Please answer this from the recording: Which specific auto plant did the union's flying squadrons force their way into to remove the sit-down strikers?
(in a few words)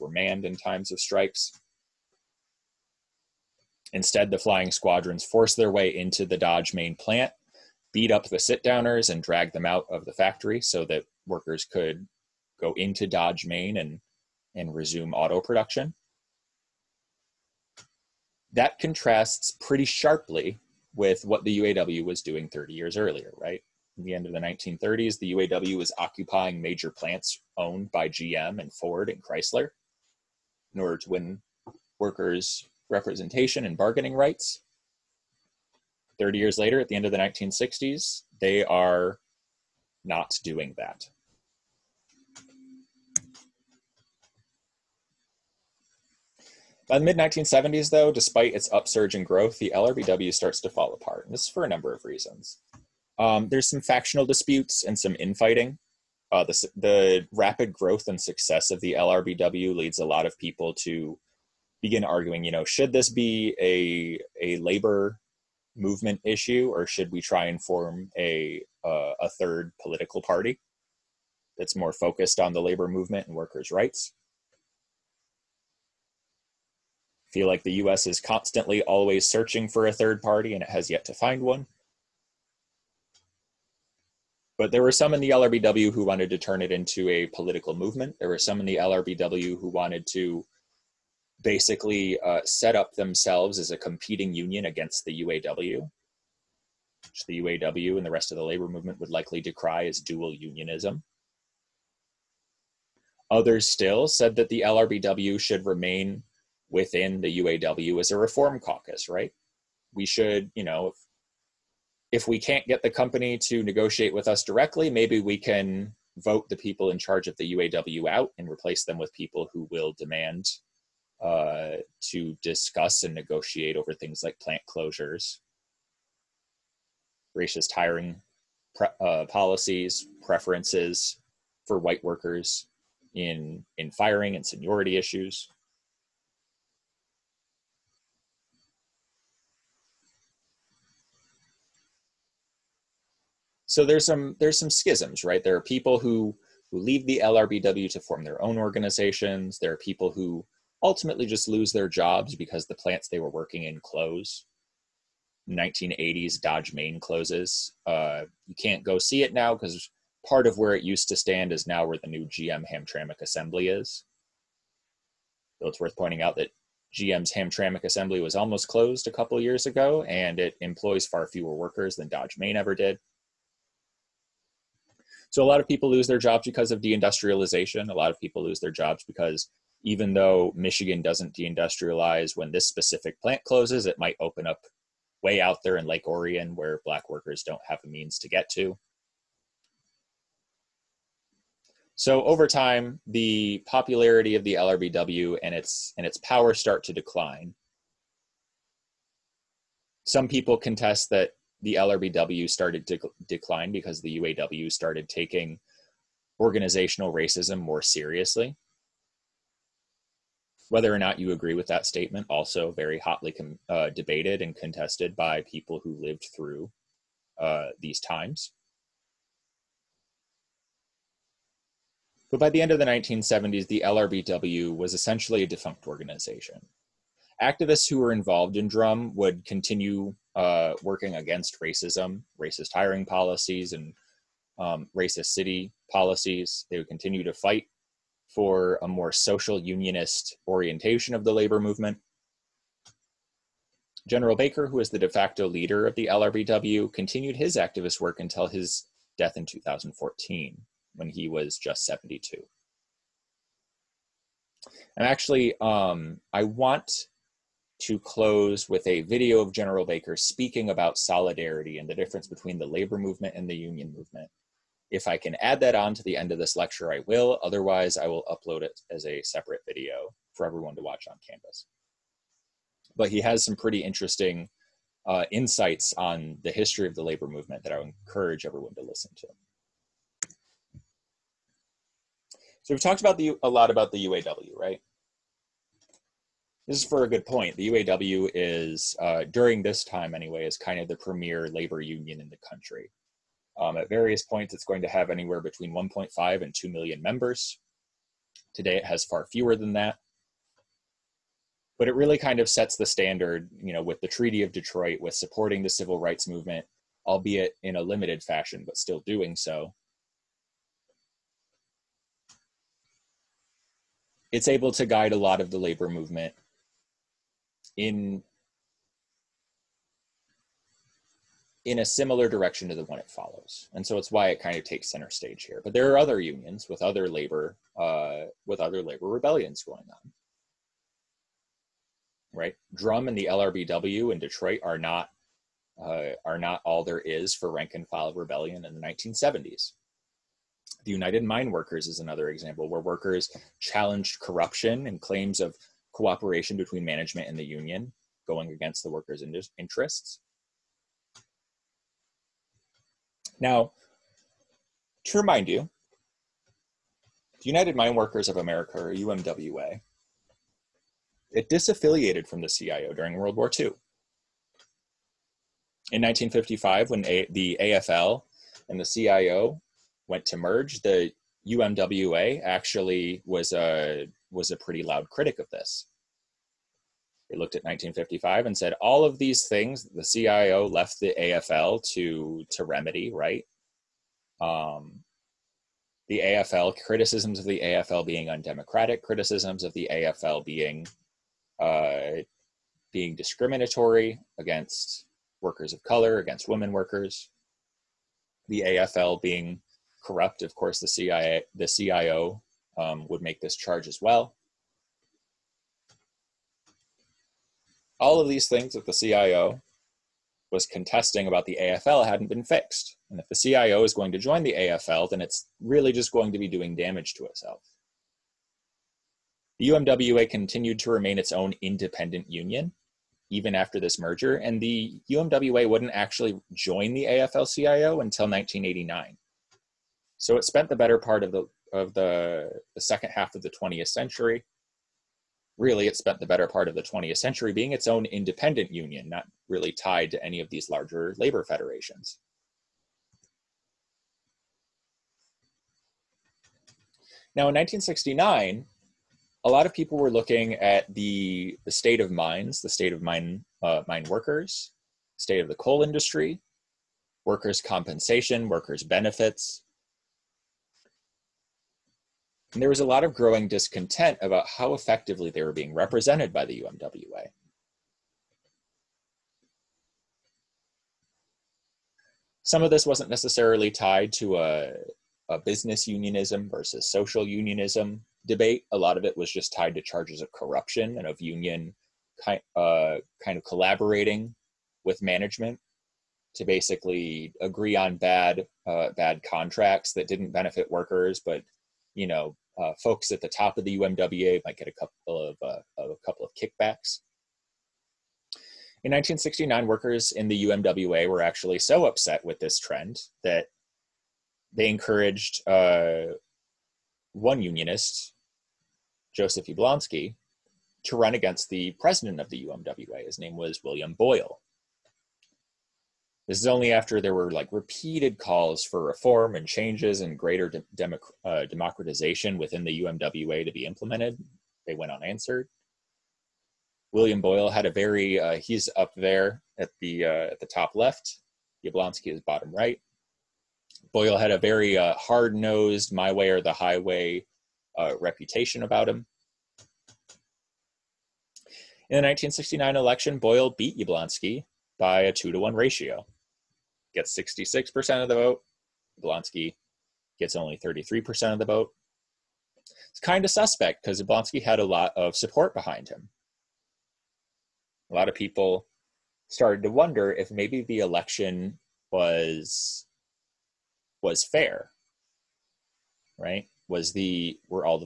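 Dodge main plant.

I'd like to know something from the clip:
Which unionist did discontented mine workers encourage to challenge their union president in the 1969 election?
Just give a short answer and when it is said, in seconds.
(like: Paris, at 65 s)
Joseph Yablonski, at 509 s.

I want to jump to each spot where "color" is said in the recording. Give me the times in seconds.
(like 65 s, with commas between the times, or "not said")
395 s.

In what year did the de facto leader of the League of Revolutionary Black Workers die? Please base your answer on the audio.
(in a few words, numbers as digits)
2014.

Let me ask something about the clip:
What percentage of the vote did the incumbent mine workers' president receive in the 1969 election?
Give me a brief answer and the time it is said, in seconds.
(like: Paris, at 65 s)
66%, at 547 s.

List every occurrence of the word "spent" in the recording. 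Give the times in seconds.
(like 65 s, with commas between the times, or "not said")
430 s, 435 s.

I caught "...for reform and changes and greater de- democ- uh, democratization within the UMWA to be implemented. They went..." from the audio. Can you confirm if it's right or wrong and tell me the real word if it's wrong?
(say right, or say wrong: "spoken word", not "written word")
right.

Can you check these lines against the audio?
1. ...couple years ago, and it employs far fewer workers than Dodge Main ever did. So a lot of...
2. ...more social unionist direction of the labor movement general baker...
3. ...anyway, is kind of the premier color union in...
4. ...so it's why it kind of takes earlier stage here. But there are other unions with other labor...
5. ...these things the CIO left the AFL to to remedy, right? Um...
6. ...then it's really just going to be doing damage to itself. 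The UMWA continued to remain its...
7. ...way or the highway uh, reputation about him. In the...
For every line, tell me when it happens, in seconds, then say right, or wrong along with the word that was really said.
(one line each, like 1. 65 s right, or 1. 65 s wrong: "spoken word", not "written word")
1. 169 s right
2. 238 s wrong: "orientation", not "direction"
3. 290 s wrong: "labor", not "color"
4. 323 s wrong: "center", not "earlier"
5. 379 s right
6. 415 s right
7. 536 s right.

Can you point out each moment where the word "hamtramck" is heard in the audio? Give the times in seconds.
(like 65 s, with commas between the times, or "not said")
162 s, 167 s.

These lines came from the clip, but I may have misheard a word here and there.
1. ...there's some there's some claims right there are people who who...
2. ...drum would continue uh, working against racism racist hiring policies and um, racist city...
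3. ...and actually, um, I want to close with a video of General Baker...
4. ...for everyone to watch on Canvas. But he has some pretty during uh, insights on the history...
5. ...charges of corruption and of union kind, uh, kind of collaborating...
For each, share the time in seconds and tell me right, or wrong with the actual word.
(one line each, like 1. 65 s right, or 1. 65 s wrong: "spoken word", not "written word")
1. 143 s wrong: "schisms", not "claims"
2. 228 s right
3. 254 s right
4. 270 s wrong: "interesting", not "during"
5. 479 s right.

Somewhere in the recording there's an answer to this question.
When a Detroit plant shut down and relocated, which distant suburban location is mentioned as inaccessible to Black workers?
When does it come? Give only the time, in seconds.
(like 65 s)
185 s.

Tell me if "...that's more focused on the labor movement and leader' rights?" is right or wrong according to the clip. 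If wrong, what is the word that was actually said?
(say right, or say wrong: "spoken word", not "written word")
wrong: "workers", not "leader".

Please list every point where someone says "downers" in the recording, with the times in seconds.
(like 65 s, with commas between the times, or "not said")
8 s.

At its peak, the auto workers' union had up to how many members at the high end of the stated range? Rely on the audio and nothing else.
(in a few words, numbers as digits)
2 million.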